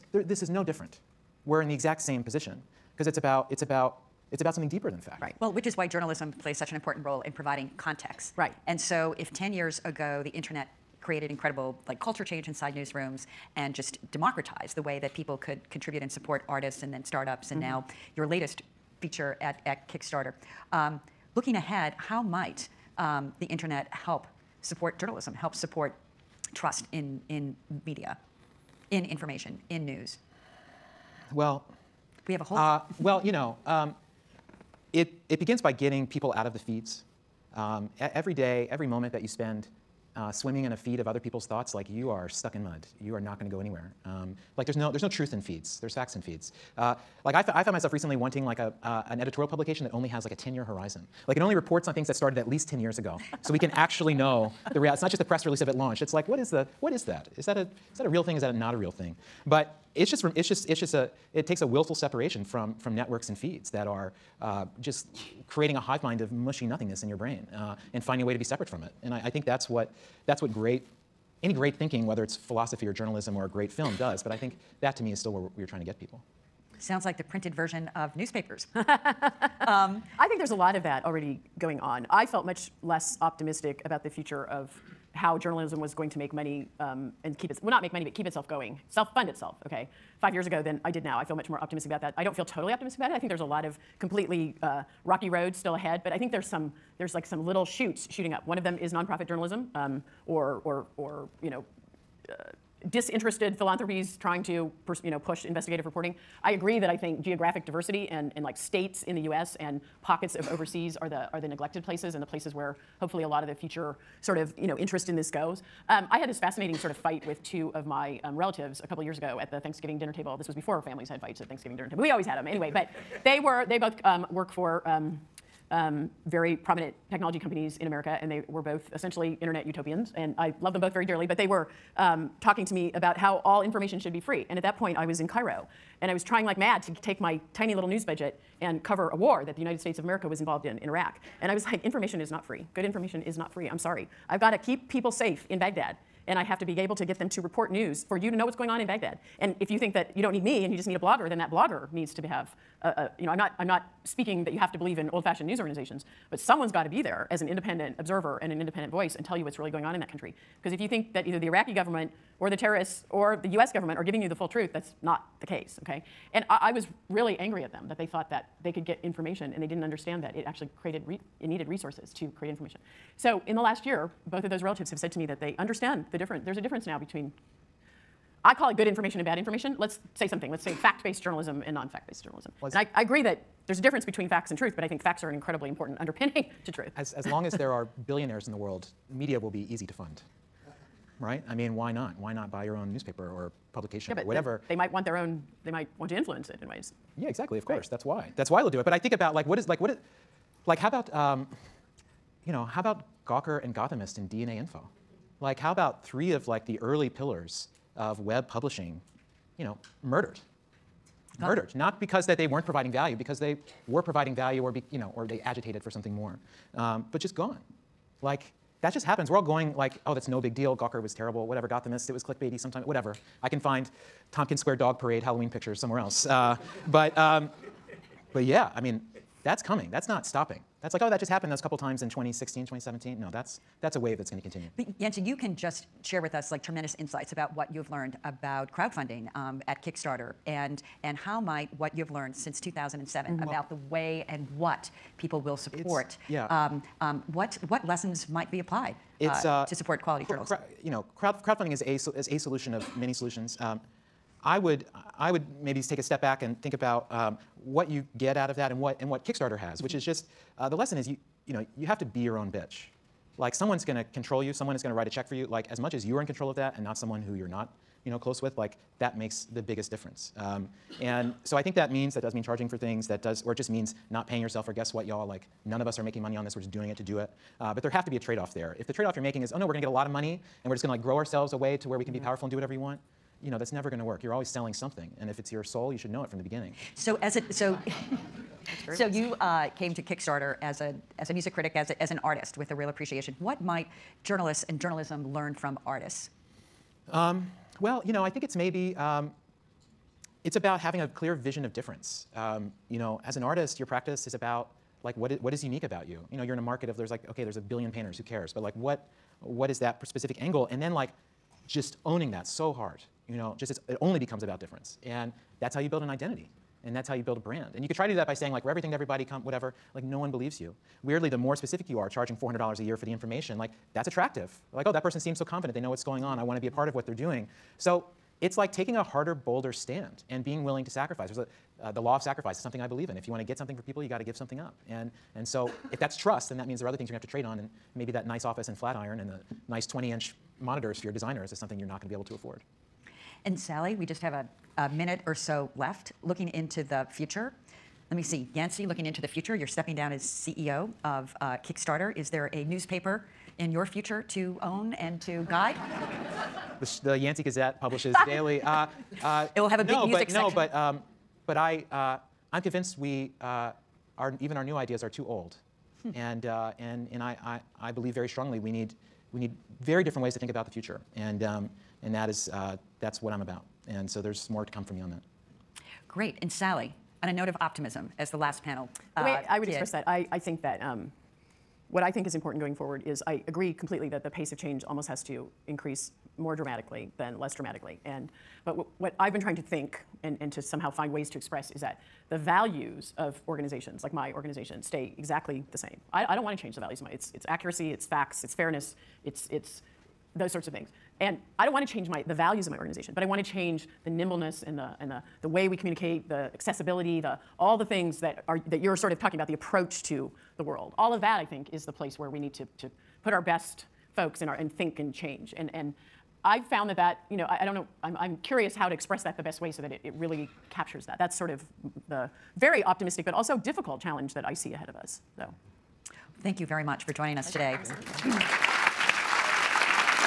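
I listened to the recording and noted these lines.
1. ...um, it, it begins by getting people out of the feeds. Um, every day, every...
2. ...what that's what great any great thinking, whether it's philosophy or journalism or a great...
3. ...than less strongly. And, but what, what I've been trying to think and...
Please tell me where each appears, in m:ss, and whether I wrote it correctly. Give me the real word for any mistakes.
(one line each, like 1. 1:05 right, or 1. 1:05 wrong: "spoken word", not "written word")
1. 0:33 right
2. 1:09 right
3. 6:27 wrong: "dramatically", not "strongly".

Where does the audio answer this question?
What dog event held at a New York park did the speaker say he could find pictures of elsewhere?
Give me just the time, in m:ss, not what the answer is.
3:44.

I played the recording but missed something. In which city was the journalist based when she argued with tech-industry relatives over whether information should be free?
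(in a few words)
Cairo.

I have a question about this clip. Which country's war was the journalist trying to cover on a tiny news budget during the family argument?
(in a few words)
Iraq.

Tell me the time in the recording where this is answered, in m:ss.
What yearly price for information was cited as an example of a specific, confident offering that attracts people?
5:22.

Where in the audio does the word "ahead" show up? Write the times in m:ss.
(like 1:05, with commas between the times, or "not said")
0:21, 1:35, 7:04.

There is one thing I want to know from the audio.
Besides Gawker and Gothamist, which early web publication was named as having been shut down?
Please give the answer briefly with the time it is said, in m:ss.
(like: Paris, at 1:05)
DNAinfo, at 3:24.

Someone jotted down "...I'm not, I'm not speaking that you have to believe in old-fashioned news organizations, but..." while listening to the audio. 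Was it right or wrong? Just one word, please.
right.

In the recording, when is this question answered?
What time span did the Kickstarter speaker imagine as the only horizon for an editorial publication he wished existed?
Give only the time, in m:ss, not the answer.
0:50.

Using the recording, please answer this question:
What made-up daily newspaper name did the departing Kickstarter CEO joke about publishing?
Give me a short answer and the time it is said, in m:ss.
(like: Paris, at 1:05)
The Yancey Gazette, at 5:57.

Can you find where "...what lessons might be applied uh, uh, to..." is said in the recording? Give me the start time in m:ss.
4:07.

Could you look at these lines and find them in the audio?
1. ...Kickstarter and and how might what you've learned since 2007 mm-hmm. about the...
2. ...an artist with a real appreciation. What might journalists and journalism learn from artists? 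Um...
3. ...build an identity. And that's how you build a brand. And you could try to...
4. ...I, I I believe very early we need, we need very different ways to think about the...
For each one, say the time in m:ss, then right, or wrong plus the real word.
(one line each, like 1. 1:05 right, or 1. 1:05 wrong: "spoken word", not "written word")
1. 3:59 right
2. 4:52 right
3. 5:15 right
4. 6:07 wrong: "strongly", not "early".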